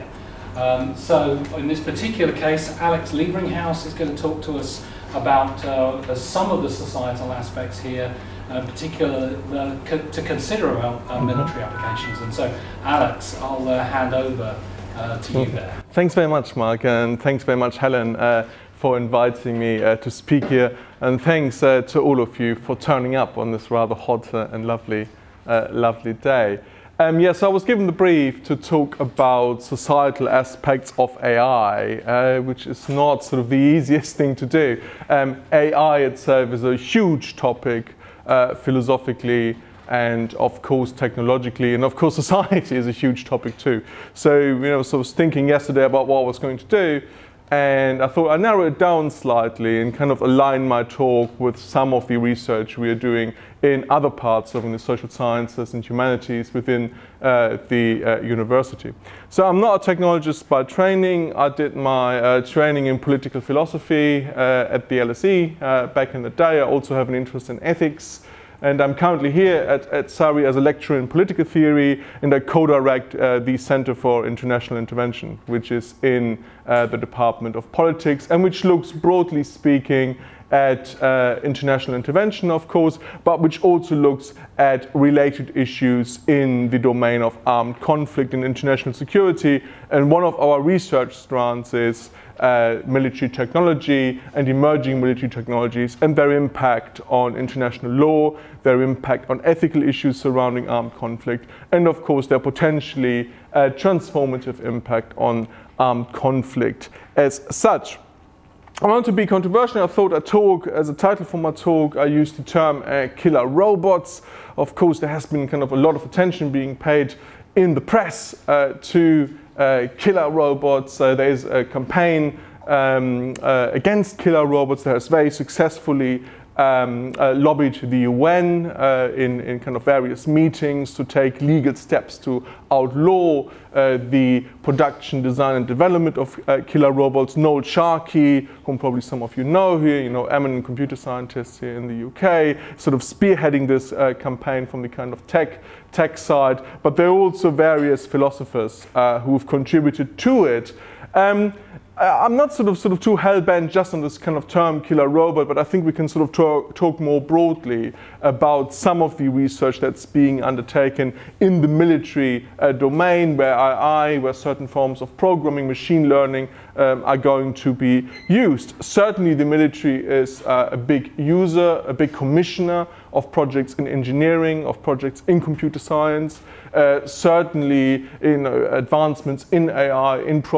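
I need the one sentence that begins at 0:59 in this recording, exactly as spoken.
So I'm not a technologist by training.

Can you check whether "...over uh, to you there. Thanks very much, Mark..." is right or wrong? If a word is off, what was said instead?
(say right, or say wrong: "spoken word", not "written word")
right.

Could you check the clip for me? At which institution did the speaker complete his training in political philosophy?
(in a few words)
LSE.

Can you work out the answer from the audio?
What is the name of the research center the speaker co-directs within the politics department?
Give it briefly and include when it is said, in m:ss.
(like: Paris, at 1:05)
Center for International Intervention, at 1:13.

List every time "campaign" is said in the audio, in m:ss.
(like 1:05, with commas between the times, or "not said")
2:01, 2:24.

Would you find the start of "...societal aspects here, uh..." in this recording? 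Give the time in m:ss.
0:06.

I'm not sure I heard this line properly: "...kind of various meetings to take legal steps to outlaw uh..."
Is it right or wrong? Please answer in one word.
right.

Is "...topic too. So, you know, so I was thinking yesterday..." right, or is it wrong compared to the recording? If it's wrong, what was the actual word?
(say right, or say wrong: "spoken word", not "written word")
right.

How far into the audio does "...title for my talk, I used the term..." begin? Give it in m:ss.
1:50.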